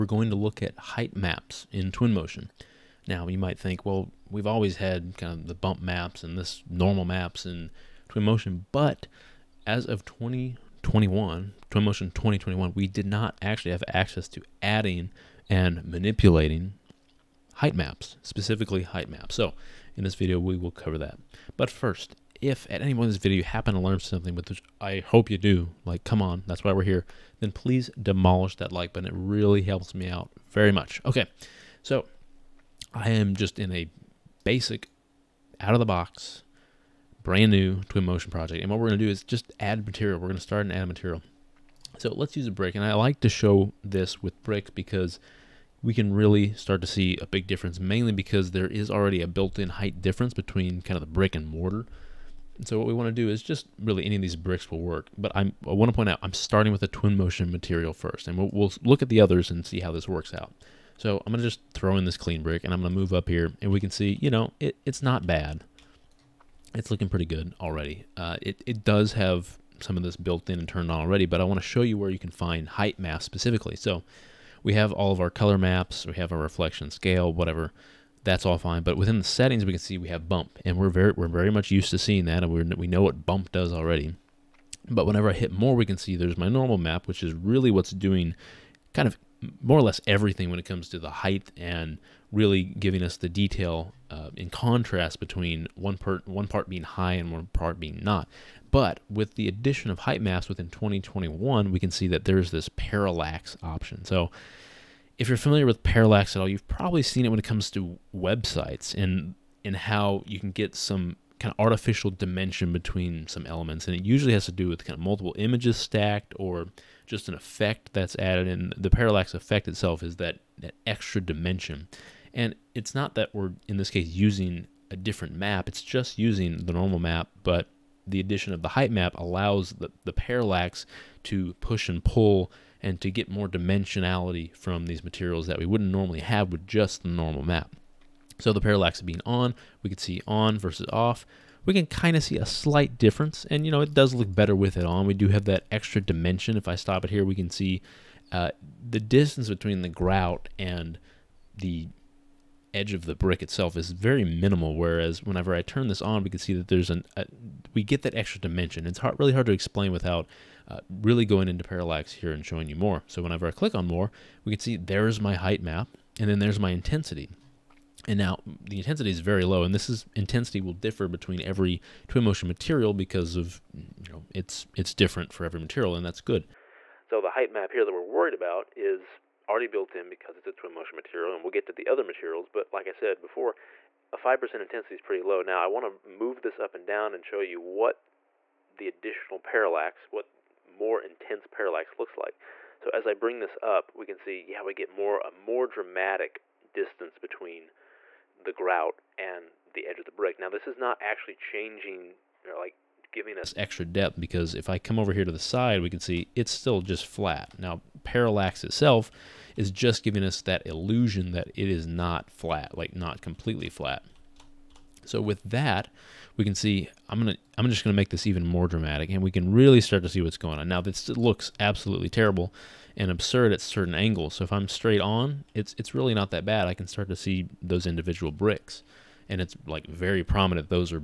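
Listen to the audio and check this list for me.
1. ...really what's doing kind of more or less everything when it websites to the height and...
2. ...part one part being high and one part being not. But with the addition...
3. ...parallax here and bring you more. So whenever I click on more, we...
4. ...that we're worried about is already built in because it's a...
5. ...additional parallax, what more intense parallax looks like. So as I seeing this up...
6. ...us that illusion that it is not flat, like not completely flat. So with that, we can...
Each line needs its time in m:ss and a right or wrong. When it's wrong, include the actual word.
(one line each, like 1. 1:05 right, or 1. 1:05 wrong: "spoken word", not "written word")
1. 1:27 wrong: "comes", not "websites"
2. 1:35 right
3. 2:41 wrong: "showing", not "bring"
4. 2:57 right
5. 3:08 wrong: "bring", not "seeing"
6. 3:30 right.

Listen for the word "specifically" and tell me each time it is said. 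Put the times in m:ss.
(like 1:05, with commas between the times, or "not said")
0:18, 1:13.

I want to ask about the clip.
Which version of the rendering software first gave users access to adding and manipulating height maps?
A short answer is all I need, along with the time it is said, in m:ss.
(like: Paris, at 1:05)
Twinmotion 2021, at 0:11.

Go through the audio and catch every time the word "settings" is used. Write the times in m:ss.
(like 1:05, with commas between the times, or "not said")
1:19.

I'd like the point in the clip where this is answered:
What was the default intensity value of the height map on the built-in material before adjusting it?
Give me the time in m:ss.
3:04.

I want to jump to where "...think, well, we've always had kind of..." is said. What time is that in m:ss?
0:03.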